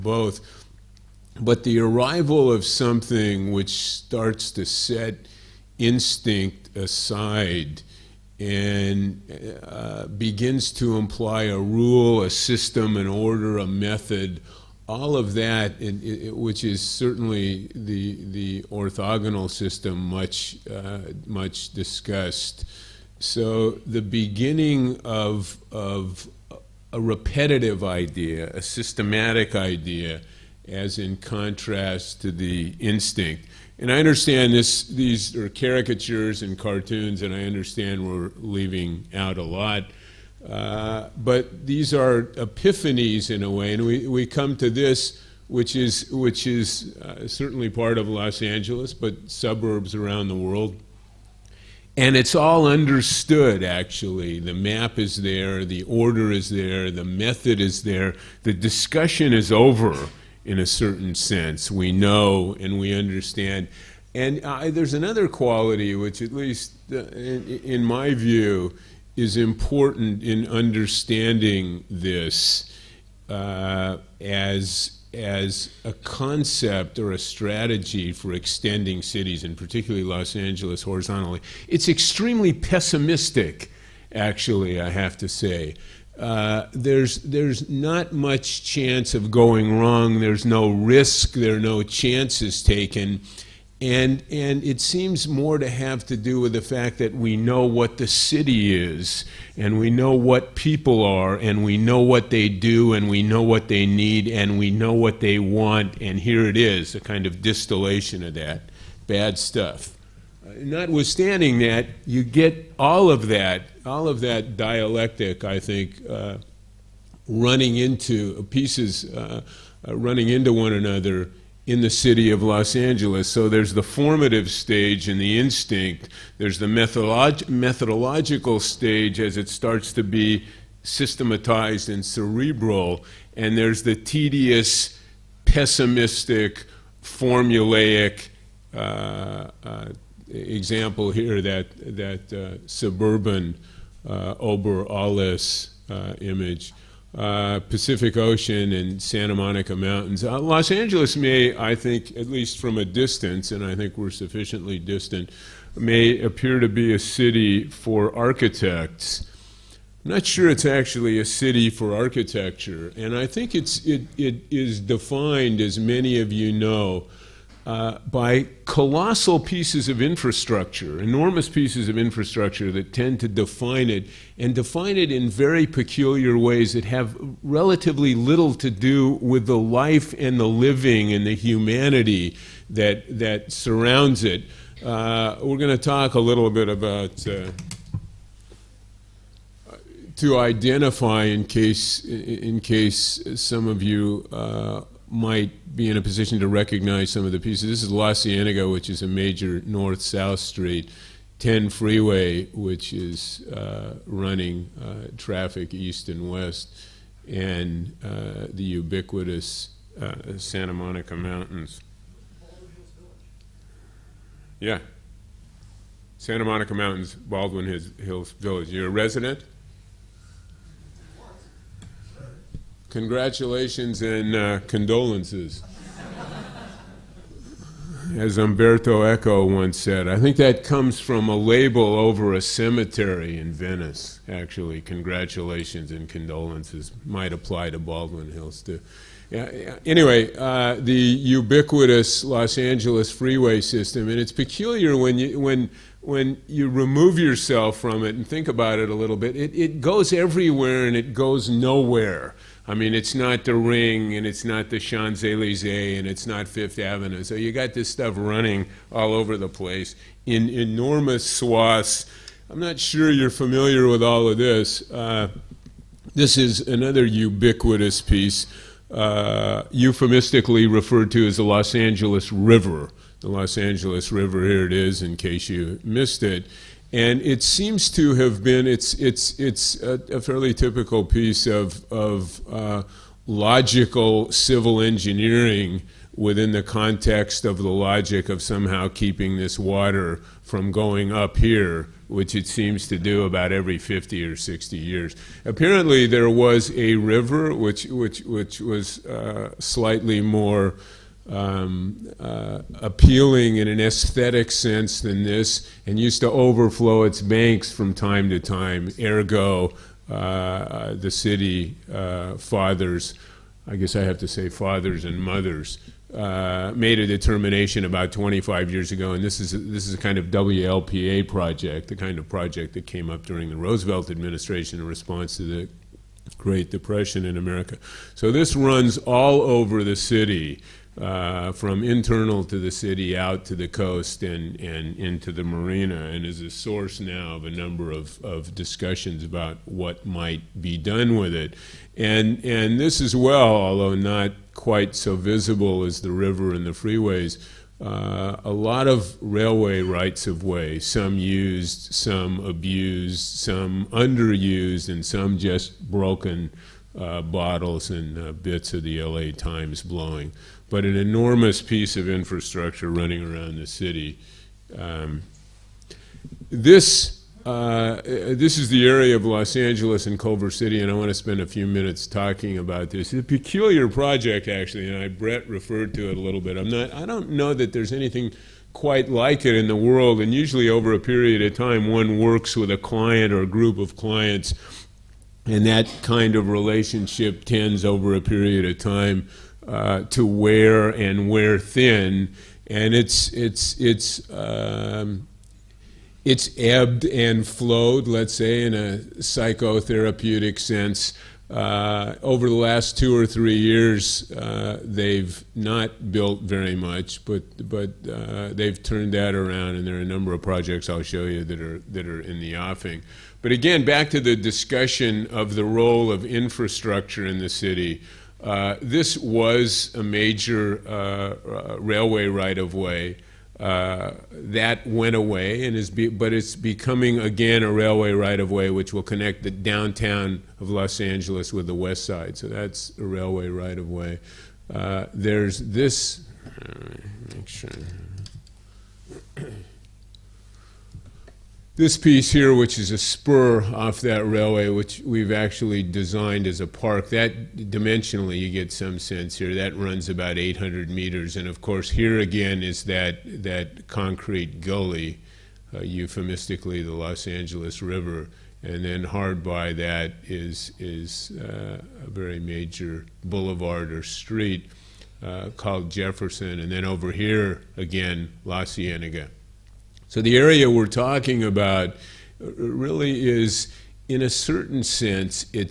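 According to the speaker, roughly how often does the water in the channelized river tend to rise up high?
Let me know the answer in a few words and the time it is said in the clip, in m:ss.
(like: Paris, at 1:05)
every 50 or 60 years, at 4:53.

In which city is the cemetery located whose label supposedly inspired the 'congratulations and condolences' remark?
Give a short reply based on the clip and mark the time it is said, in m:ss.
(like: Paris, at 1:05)
Venice, at 3:53.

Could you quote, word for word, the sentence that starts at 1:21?
It's extremely pessimistic, actually, I have to say.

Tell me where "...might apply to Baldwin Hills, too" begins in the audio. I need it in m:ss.
3:57.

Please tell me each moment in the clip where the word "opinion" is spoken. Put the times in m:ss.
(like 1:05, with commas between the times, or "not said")
not said.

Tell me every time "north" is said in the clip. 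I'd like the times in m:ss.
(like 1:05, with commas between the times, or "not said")
3:19.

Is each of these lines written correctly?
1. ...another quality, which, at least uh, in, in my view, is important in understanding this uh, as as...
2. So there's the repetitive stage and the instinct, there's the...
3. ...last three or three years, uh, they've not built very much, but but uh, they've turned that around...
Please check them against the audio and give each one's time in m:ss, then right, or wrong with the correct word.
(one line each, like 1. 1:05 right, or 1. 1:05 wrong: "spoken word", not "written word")
1. 1:04 right
2. 2:03 wrong: "formative", not "repetitive"
3. 6:42 wrong: "two", not "three".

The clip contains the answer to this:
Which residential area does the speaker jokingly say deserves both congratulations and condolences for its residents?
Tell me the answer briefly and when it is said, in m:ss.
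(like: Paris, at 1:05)
Baldwin Hills Village, at 3:37.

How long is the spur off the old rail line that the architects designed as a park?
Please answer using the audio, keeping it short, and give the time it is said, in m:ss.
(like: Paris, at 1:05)
800 meters, at 7:30.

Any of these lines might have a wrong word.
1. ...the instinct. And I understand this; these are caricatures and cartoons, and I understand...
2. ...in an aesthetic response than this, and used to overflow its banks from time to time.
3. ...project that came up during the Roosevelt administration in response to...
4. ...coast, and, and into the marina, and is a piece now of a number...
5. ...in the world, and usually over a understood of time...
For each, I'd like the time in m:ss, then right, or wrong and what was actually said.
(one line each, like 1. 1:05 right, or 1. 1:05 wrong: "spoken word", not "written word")
1. 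0:32 right
2. 5:03 wrong: "sense", not "response"
3. 5:22 right
4. 5:33 wrong: "source", not "piece"
5. 6:19 wrong: "period", not "understood".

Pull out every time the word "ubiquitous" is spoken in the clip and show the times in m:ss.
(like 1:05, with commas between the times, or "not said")
3:28, 4:00, 4:27.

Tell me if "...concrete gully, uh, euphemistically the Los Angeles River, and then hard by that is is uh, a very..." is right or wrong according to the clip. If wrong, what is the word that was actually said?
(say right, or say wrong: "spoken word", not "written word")
right.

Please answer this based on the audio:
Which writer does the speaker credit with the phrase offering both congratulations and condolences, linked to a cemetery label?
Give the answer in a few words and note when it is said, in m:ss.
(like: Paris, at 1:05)
Umberto Eco, at 3:48.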